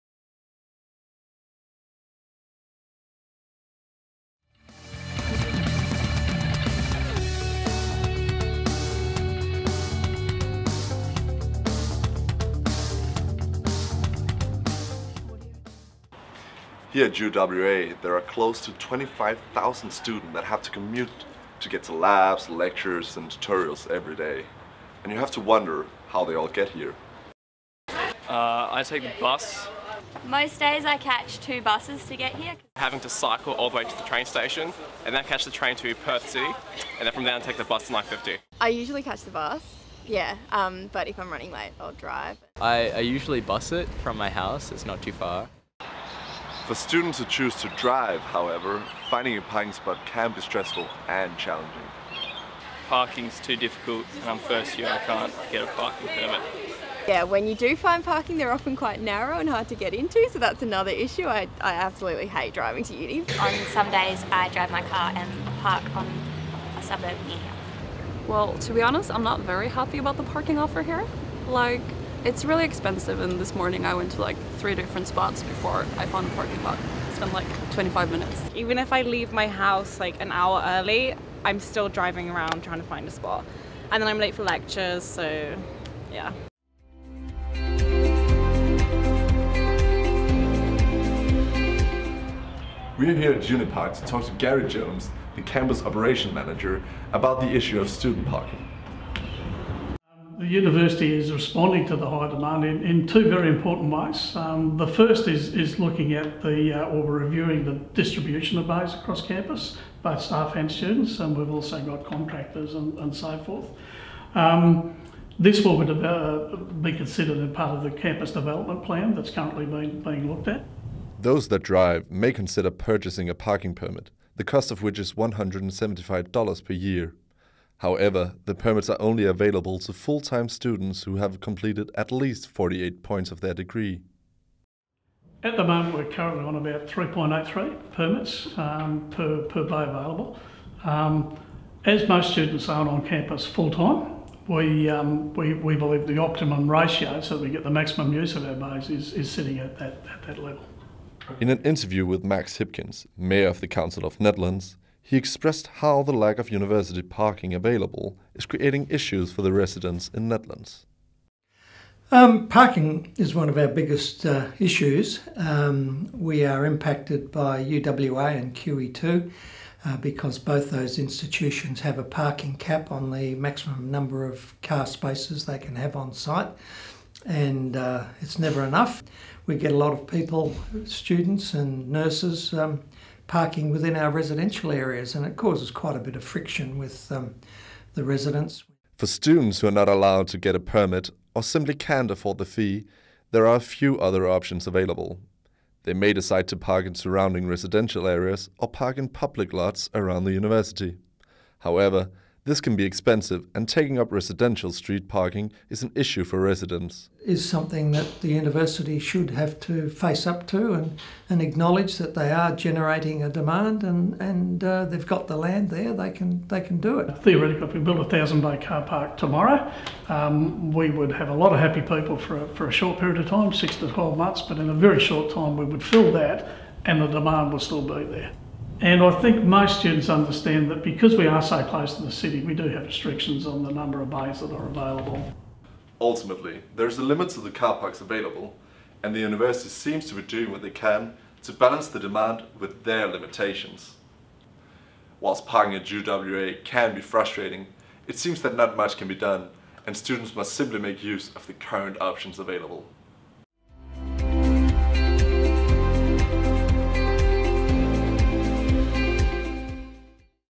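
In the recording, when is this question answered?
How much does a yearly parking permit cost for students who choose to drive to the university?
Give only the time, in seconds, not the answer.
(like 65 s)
125 s.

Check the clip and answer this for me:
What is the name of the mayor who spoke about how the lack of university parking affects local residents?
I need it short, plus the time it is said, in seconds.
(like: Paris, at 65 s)
Max Hipkins, at 152 s.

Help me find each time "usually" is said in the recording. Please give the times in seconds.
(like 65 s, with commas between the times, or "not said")
38 s, 42 s.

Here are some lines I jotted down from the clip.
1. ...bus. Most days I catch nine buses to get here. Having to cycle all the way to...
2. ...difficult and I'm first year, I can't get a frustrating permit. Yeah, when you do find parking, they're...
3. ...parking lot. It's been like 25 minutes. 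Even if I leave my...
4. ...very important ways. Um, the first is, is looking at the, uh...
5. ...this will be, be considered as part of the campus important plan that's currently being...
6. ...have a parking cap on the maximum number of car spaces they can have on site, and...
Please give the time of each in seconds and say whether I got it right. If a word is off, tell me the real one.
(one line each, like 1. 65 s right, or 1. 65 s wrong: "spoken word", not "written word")
1. 29 s wrong: "two", not "nine"
2. 53 s wrong: "parking", not "frustrating"
3. 76 s right
4. 103 s right
5. 115 s wrong: "development", not "important"
6. 171 s right.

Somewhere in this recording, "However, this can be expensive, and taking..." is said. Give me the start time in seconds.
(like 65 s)
201 s.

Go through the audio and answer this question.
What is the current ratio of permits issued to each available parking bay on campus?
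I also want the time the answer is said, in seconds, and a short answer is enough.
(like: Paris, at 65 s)
3.83, at 136 s.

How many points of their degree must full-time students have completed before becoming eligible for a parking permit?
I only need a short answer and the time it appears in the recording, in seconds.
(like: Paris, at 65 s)
48, at 132 s.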